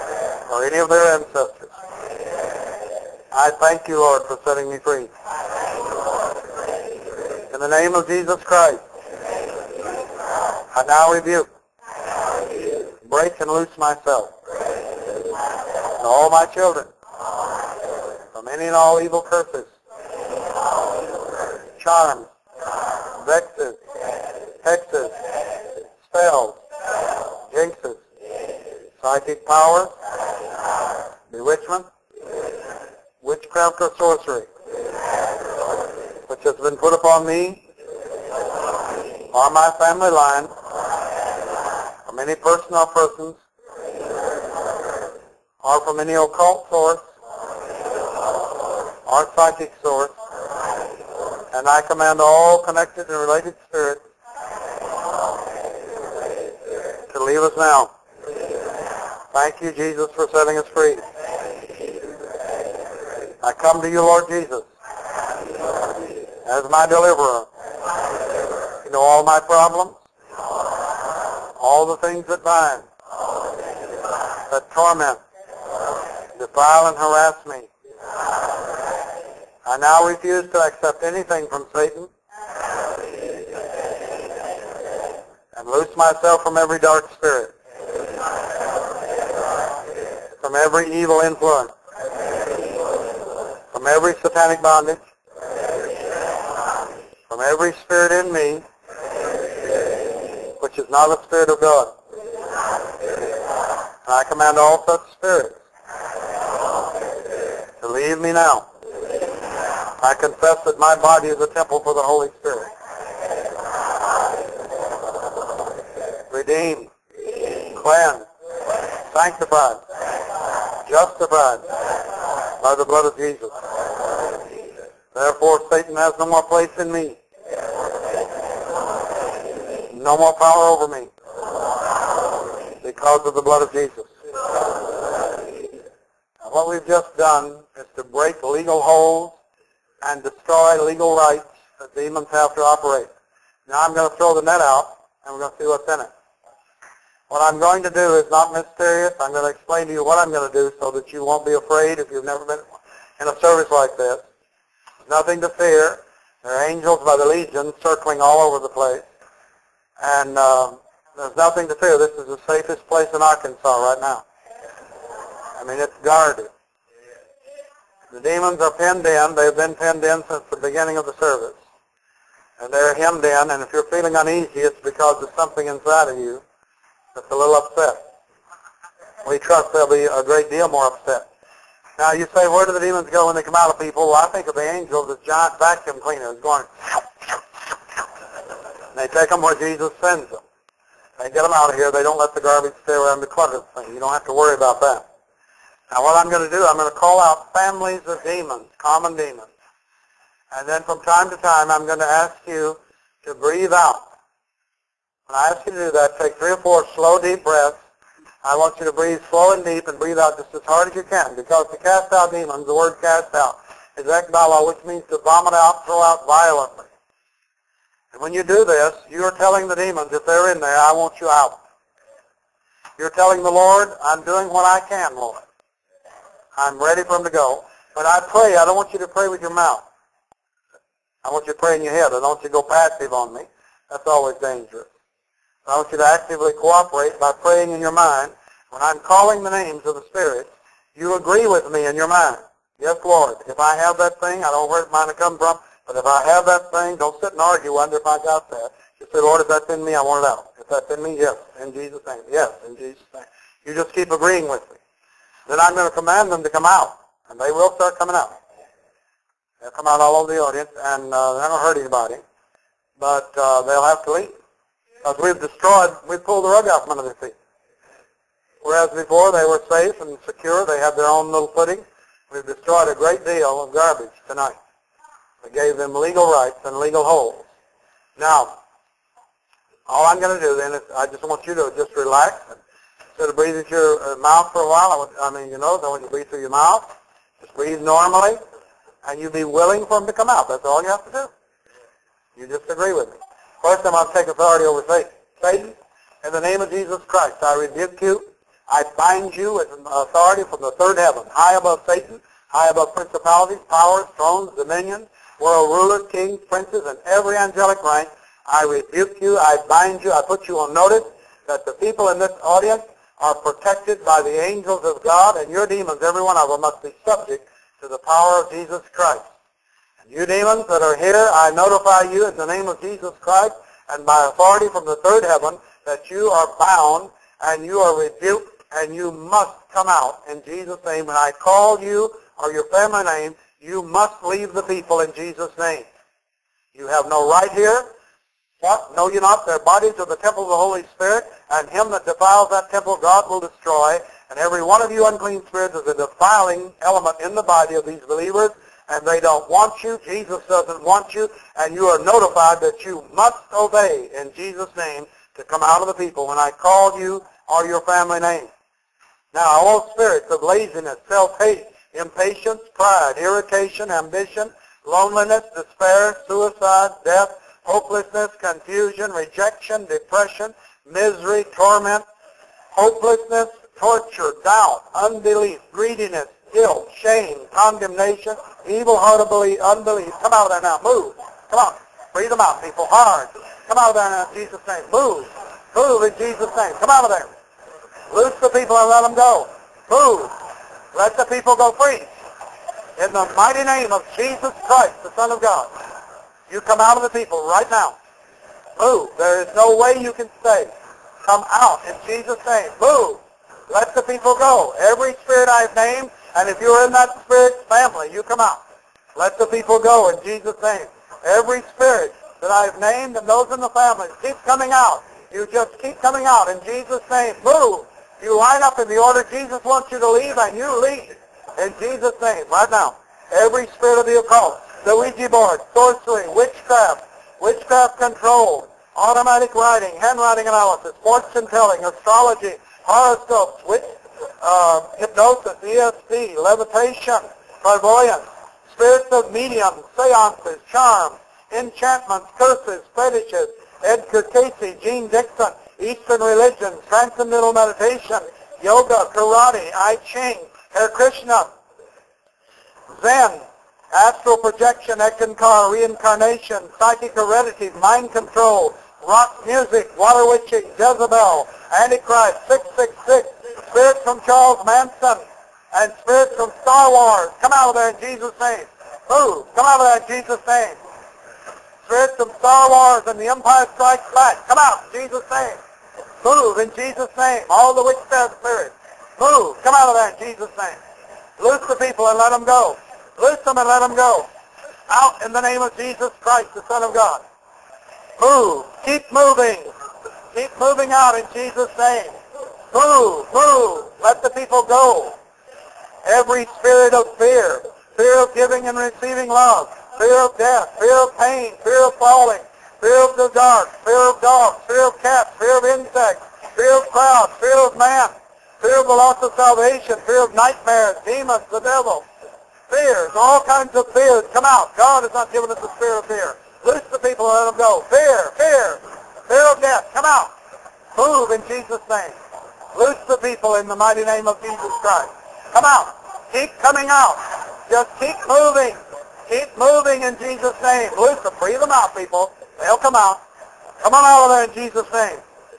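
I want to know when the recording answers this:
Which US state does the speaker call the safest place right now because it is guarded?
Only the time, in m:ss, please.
2:43.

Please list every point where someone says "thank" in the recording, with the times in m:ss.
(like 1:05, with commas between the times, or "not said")
0:03, 0:59.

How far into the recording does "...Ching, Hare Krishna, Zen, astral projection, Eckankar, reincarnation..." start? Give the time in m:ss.
7:30.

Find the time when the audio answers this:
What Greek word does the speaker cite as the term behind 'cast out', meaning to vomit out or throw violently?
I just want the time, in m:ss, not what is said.
3:34.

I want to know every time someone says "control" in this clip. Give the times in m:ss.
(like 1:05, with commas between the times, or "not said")
7:07, 7:38.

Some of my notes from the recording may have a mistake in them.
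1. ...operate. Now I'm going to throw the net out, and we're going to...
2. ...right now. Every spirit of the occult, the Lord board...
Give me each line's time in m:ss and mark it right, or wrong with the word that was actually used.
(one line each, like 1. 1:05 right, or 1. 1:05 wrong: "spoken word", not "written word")
1. 2:22 right
2. 7:02 wrong: "Ouija", not "Lord".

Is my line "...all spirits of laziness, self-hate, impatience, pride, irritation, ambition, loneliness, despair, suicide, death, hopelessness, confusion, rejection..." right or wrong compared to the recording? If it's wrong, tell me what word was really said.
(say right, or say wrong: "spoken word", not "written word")
right.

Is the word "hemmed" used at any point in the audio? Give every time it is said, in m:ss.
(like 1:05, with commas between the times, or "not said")
2:52.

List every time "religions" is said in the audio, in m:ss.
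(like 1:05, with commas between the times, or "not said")
7:26.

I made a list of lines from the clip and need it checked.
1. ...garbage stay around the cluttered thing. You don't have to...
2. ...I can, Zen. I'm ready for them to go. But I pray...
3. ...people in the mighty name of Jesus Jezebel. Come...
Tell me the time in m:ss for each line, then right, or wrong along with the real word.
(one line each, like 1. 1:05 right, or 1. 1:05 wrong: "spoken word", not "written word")
1. 3:12 right
2. 3:44 wrong: "Lord", not "Zen"
3. 8:43 wrong: "Christ", not "Jezebel".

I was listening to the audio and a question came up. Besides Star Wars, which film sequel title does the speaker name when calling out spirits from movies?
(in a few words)
The Empire Strikes Back.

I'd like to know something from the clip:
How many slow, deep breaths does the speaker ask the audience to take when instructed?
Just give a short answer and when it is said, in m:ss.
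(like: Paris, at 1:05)
3 or 4, at 3:26.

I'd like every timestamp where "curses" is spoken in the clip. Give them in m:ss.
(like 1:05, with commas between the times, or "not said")
0:19, 7:22.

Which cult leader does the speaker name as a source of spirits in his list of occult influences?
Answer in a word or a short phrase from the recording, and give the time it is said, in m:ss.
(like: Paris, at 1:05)
Charles Manson, at 7:44.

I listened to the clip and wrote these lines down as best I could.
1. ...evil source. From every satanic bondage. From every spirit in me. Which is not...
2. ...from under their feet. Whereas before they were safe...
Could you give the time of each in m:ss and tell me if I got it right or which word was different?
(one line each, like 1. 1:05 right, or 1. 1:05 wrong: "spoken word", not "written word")
1. 1:30 wrong: "influence", not "source"
2. 4:26 right.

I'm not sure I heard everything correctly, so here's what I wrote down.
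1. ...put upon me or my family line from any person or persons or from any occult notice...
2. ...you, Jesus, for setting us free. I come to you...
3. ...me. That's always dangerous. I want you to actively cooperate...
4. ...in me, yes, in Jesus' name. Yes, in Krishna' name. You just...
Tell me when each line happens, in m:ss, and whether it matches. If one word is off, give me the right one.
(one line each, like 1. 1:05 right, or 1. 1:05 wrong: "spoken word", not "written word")
1. 0:36 wrong: "source", not "notice"
2. 0:59 right
3. 3:53 right
4. 4:10 wrong: "Jesus", not "Krishna".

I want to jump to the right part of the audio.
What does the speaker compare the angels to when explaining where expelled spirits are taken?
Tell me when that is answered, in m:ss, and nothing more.
3:05.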